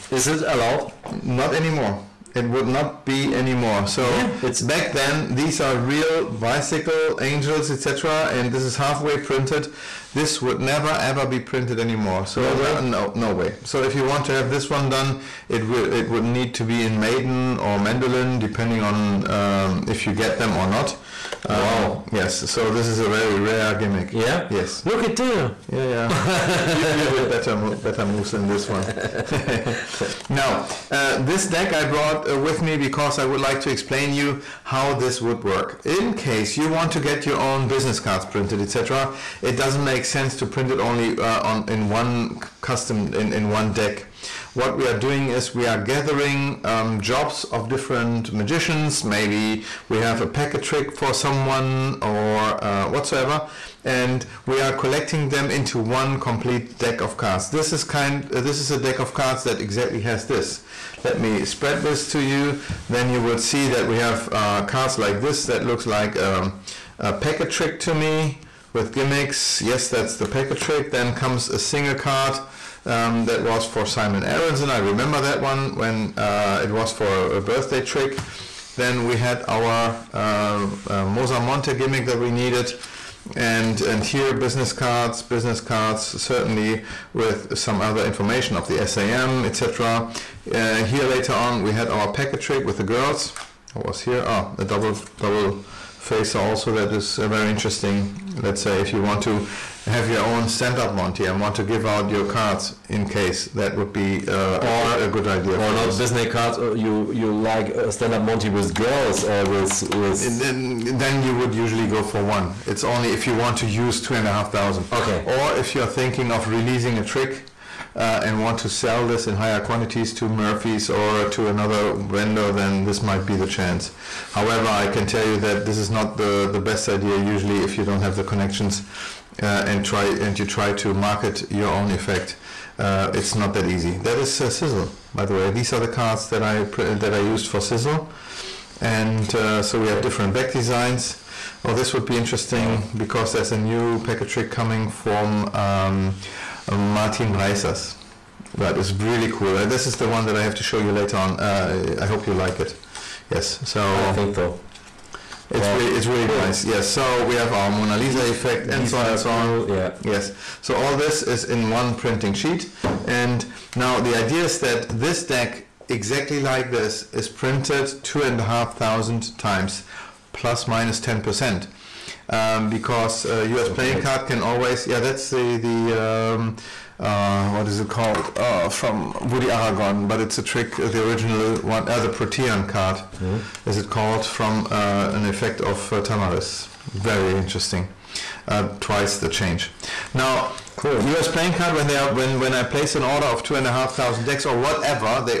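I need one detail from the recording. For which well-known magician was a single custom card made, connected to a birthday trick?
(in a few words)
Simon Aronson.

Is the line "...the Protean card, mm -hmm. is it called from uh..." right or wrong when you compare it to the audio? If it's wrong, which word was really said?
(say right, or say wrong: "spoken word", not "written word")
right.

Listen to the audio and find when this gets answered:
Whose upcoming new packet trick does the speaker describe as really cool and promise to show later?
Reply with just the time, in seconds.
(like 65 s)
146 s.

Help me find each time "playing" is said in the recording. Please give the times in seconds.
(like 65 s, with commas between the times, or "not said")
173 s, 191 s.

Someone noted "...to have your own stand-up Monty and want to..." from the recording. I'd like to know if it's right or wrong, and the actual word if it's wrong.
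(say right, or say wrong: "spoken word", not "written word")
right.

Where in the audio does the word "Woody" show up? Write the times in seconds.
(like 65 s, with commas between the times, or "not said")
179 s.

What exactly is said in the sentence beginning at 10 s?
This would never ever be printed anymore.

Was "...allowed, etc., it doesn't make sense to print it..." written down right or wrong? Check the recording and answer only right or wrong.
wrong.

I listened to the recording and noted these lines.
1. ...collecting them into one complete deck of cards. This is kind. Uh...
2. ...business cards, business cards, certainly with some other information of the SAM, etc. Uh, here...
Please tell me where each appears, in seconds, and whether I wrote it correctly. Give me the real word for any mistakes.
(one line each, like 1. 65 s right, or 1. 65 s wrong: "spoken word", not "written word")
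1. 54 s right
2. 84 s right.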